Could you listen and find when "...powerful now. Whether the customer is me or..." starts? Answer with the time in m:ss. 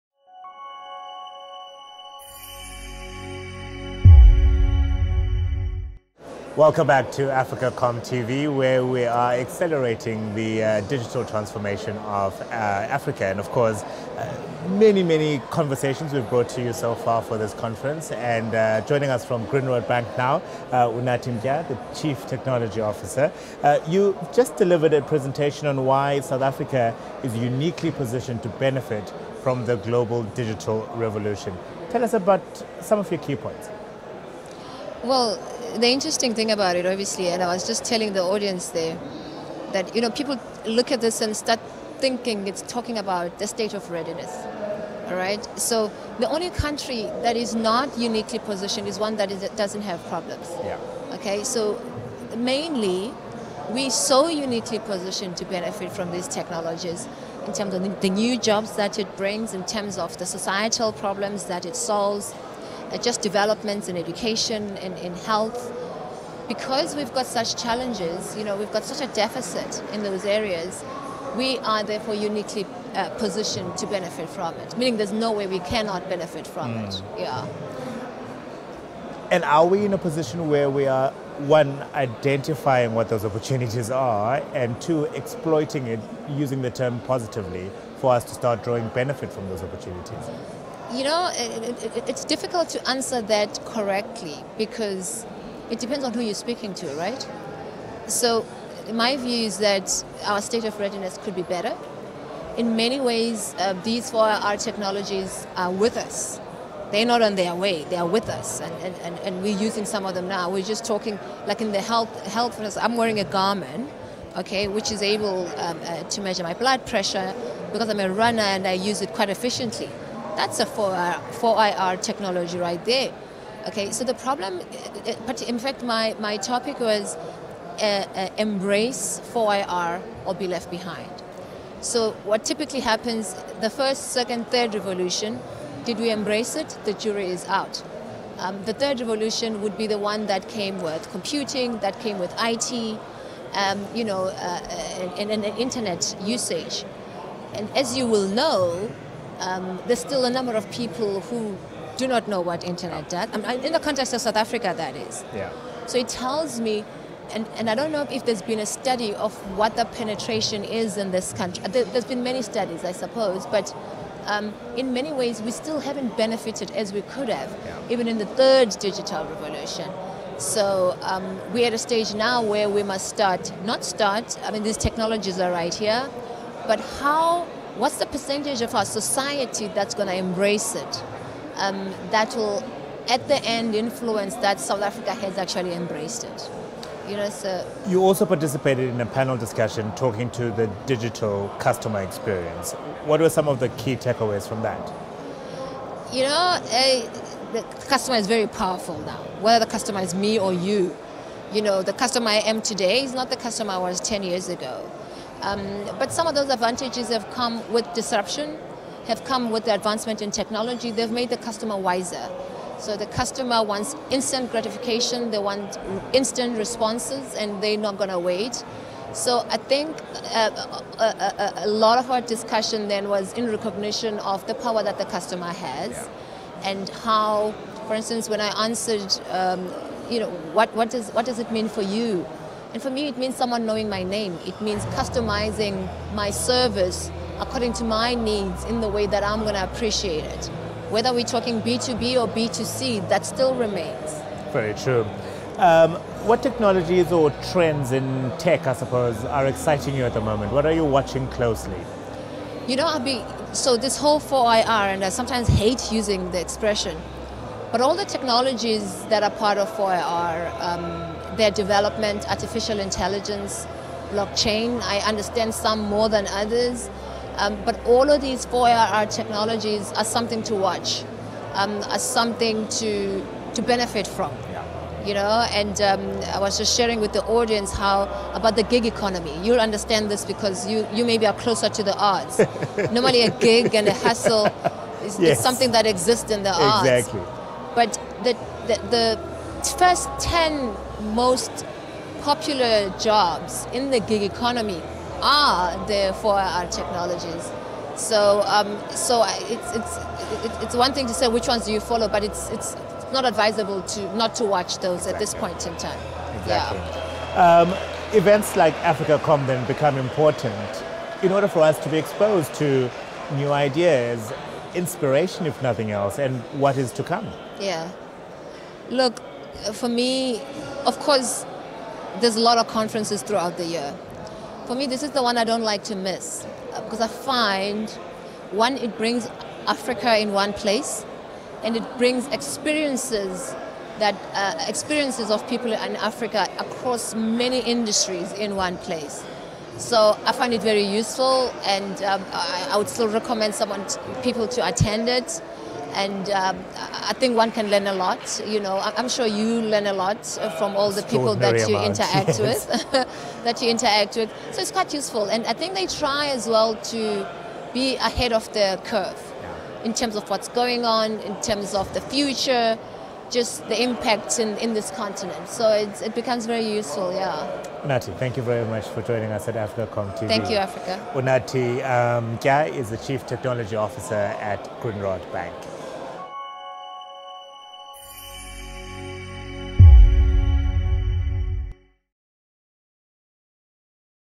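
3:18.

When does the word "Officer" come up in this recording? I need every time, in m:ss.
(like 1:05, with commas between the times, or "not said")
0:22, 6:13.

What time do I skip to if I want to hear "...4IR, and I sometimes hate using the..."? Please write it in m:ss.
4:14.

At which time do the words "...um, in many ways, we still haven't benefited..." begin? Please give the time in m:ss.
2:44.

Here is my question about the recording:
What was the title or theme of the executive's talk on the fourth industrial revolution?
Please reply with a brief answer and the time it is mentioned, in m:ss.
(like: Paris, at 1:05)
embrace 4IR or be left behind, at 2:08.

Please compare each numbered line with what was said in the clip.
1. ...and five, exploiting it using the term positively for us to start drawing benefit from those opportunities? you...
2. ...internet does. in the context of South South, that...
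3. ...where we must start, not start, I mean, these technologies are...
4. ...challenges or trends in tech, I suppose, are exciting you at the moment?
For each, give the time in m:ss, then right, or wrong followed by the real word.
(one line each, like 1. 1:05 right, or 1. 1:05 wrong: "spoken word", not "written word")
1. 1:24 wrong: "two", not "five"
2. 2:32 wrong: "Africa", not "South"
3. 2:52 right
4. 4:06 wrong: "technologies", not "challenges".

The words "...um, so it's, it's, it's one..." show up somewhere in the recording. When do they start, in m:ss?
4:58.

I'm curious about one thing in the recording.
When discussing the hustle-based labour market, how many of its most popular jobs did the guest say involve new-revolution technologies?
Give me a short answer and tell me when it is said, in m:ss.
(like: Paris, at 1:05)
10, at 4:49.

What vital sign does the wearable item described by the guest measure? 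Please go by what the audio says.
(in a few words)
blood pressure.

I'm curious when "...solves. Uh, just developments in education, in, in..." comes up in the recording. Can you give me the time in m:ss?
1:01.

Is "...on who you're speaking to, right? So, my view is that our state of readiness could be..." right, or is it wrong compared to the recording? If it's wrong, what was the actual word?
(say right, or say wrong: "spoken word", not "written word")
right.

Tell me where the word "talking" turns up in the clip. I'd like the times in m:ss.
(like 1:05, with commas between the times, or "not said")
0:42, 1:50, 3:09, 4:01.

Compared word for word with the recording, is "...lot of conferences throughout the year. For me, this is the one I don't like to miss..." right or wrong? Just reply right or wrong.
right.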